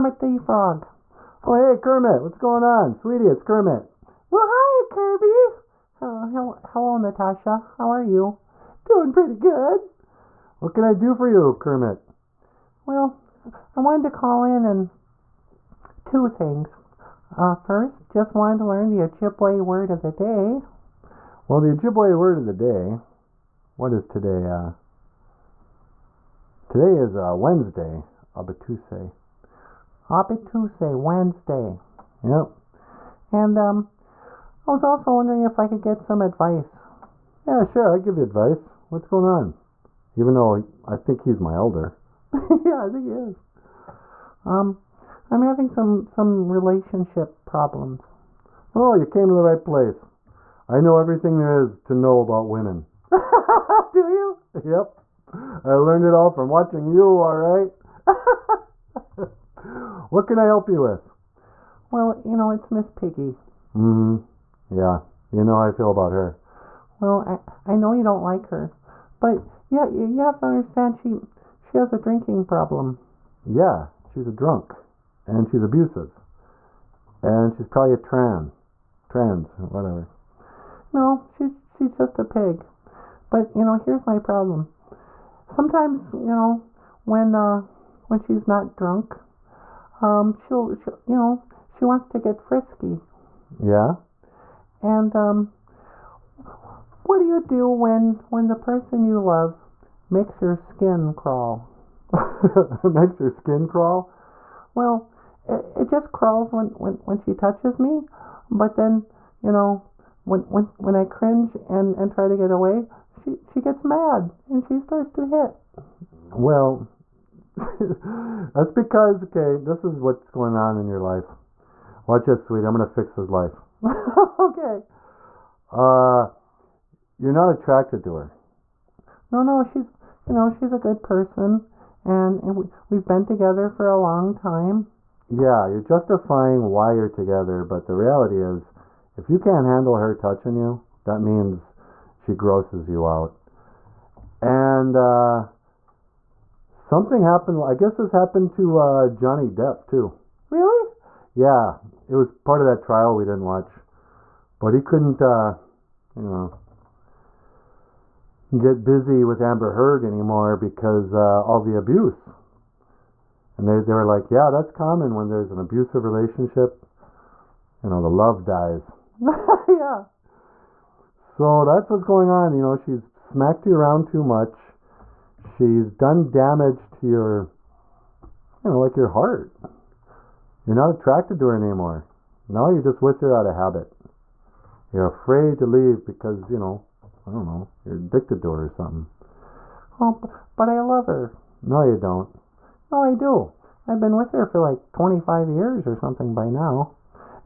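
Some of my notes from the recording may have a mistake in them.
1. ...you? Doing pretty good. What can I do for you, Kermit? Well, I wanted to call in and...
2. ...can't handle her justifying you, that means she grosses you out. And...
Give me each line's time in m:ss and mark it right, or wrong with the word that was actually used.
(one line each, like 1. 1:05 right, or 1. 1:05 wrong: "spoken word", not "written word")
1. 0:08 right
2. 2:19 wrong: "touching", not "justifying".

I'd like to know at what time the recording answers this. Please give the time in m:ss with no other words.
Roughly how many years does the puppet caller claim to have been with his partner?
3:14.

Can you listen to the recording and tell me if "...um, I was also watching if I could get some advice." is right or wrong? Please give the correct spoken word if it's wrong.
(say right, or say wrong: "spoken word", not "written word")
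wrong: "wondering", not "watching".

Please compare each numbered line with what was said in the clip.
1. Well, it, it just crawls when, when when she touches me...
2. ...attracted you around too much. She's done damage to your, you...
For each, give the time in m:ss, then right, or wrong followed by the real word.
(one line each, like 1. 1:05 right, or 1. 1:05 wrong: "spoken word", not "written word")
1. 1:44 right
2. 2:53 wrong: "smacked", not "attracted".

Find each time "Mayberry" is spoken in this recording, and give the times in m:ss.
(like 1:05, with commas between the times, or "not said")
not said.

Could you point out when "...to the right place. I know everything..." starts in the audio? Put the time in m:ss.
0:49.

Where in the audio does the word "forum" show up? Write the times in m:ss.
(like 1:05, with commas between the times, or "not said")
not said.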